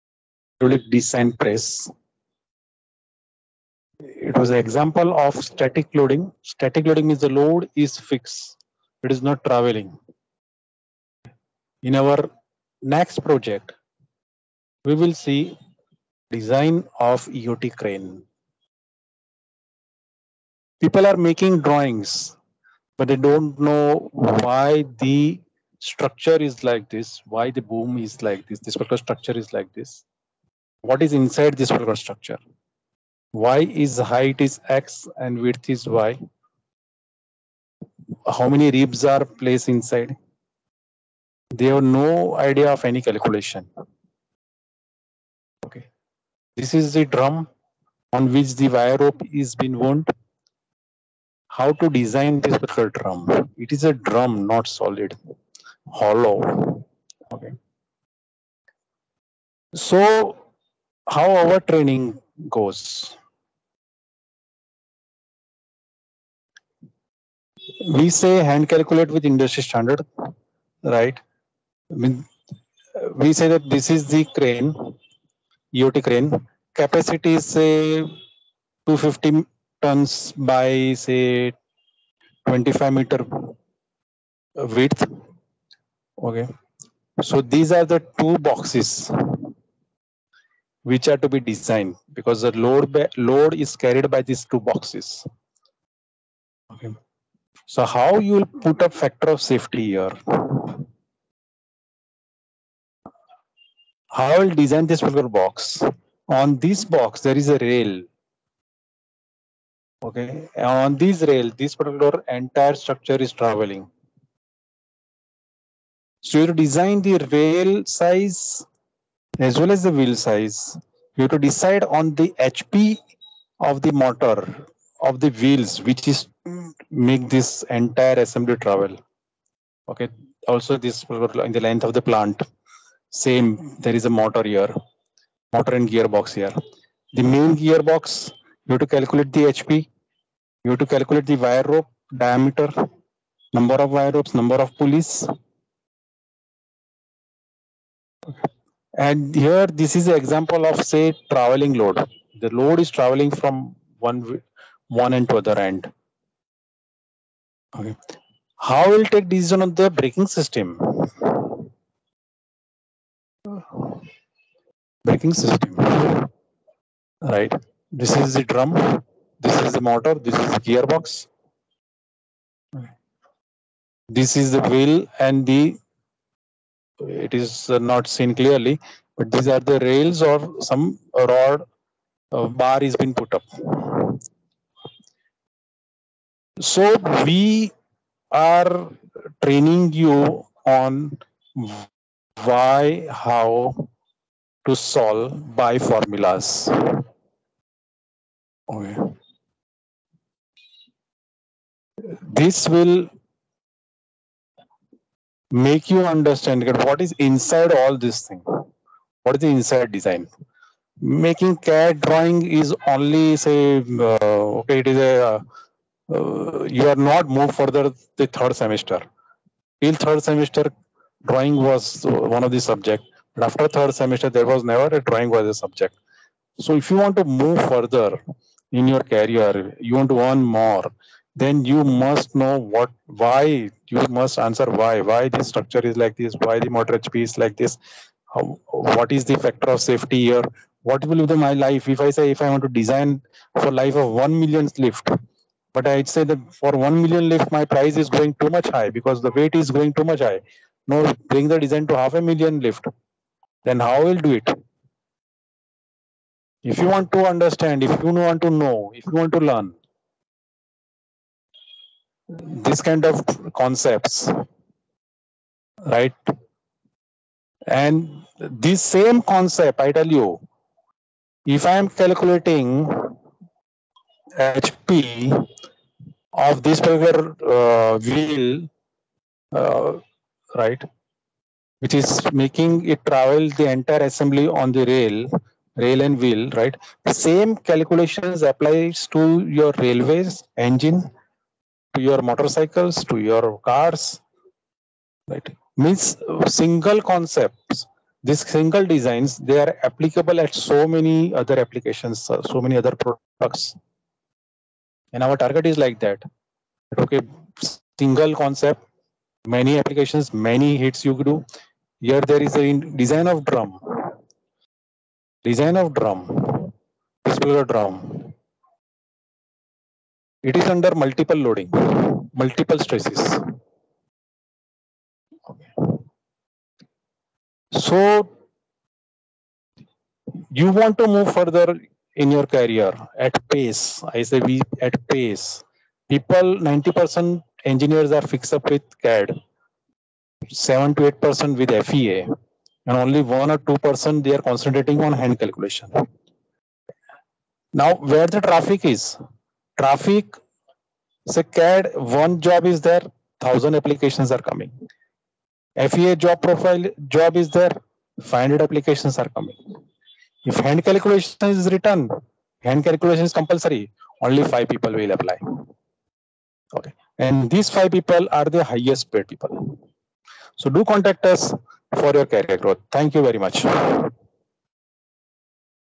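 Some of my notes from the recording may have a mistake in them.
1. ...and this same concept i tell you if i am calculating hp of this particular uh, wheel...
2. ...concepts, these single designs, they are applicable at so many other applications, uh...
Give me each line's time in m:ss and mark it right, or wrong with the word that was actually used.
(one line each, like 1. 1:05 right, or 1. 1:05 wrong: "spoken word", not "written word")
1. 4:27 right
2. 4:57 right.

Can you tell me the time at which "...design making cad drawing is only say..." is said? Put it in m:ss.
3:29.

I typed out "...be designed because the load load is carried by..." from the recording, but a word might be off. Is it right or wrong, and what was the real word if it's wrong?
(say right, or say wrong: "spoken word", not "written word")
right.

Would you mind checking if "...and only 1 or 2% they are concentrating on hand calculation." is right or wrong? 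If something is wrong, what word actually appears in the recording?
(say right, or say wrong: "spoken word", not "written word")
right.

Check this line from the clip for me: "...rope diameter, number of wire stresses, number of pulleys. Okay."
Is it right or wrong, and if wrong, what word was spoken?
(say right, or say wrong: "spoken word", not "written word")
wrong: "ropes", not "stresses".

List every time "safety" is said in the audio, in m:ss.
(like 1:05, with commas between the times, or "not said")
1:39, 3:59.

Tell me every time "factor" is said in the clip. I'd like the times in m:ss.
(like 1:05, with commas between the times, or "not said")
1:38, 3:59.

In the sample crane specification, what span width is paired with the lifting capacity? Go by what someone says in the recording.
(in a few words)
25 meter.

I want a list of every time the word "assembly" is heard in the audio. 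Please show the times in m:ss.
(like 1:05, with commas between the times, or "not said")
2:08, 4:44.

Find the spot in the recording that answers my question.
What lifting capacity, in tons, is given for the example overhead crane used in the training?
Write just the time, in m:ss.
1:17.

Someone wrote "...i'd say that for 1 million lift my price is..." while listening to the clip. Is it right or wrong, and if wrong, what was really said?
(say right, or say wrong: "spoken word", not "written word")
right.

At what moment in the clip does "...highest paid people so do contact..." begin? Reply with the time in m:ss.
6:08.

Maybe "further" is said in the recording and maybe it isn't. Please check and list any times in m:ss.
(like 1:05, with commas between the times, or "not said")
3:37, 3:47, 5:31.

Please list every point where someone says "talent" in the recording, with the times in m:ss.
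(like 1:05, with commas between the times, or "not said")
not said.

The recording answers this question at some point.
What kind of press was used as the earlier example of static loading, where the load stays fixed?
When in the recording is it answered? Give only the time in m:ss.
0:00.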